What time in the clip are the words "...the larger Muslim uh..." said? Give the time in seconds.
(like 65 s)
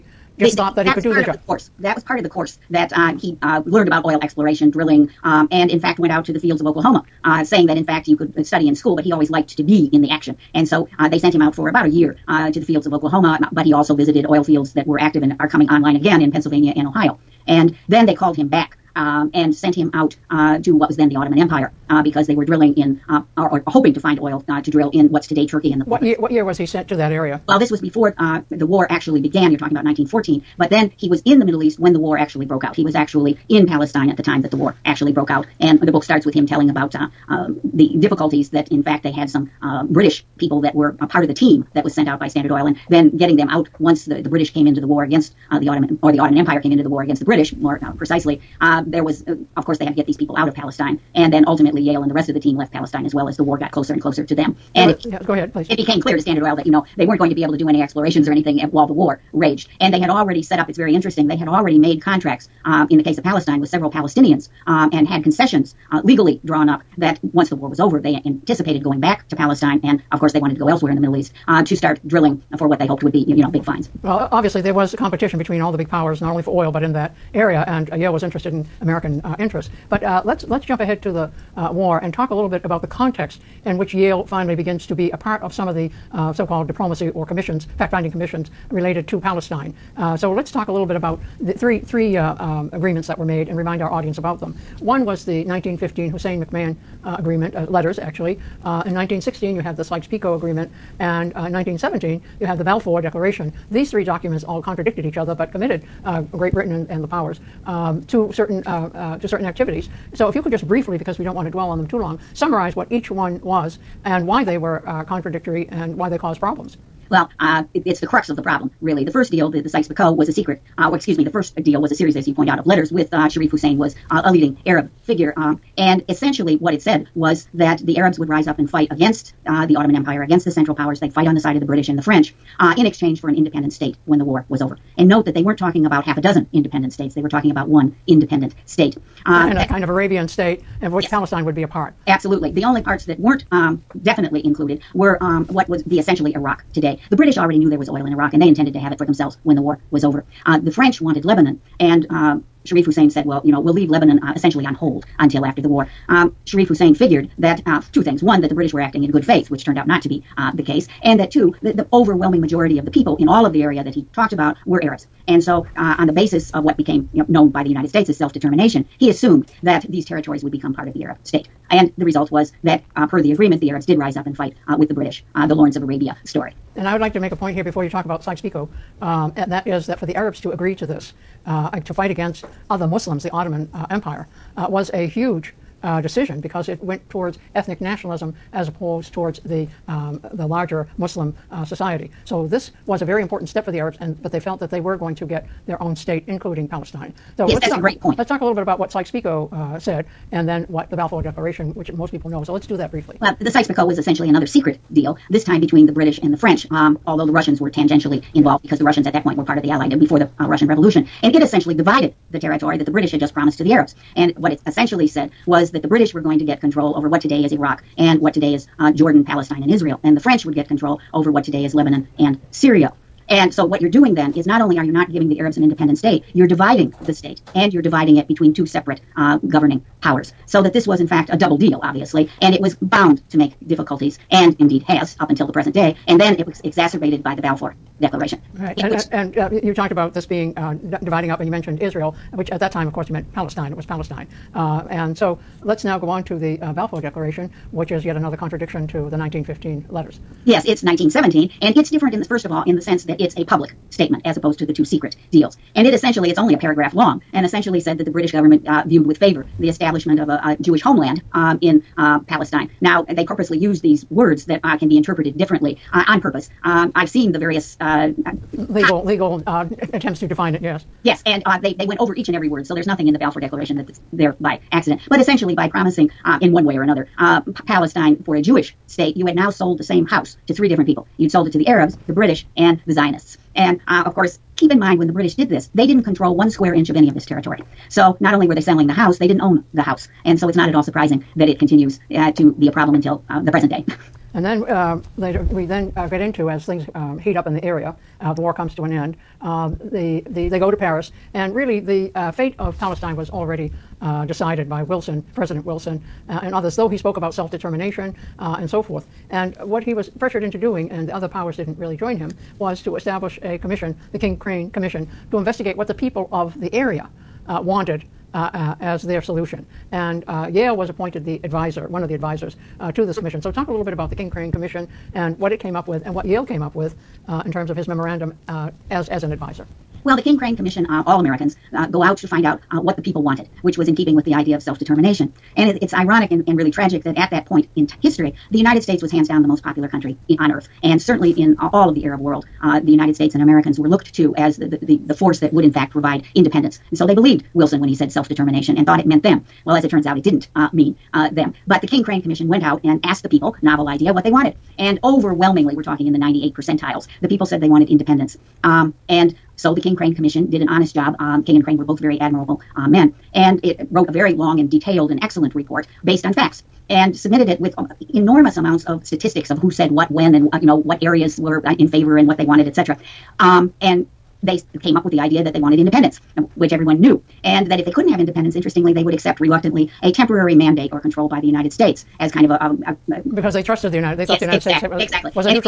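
190 s.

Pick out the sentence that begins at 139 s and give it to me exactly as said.
Uh, and a eh, kind of Arabian state of which yes.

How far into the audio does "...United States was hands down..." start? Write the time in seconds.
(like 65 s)
338 s.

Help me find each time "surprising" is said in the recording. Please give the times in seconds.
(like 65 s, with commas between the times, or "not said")
290 s.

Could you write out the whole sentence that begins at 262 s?
Now, they purposely used these words that uh, can be interpreted differently uh, on purpose.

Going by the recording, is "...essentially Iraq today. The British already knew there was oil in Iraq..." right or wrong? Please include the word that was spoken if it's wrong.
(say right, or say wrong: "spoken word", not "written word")
right.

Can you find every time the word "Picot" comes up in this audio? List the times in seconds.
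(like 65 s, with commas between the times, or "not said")
99 s, 119 s, 178 s, 198 s, 203 s.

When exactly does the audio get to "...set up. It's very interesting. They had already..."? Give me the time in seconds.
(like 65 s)
60 s.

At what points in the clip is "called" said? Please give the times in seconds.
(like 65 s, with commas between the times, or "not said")
18 s, 86 s.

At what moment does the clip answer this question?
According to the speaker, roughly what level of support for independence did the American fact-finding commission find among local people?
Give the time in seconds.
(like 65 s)
356 s.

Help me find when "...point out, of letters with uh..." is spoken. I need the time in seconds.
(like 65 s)
122 s.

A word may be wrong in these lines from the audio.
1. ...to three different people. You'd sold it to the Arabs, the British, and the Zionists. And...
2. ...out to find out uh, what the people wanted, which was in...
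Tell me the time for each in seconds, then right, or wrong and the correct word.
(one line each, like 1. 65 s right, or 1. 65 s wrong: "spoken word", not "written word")
1. 280 s right
2. 332 s right.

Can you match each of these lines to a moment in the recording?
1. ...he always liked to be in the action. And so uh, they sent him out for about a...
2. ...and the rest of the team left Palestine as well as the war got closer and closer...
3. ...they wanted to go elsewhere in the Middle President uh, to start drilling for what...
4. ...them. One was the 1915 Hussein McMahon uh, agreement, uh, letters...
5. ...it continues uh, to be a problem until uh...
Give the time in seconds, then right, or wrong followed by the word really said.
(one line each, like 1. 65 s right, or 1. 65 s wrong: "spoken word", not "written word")
1. 9 s right
2. 52 s right
3. 70 s wrong: "East", not "President"
4. 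94 s right
5. 291 s right.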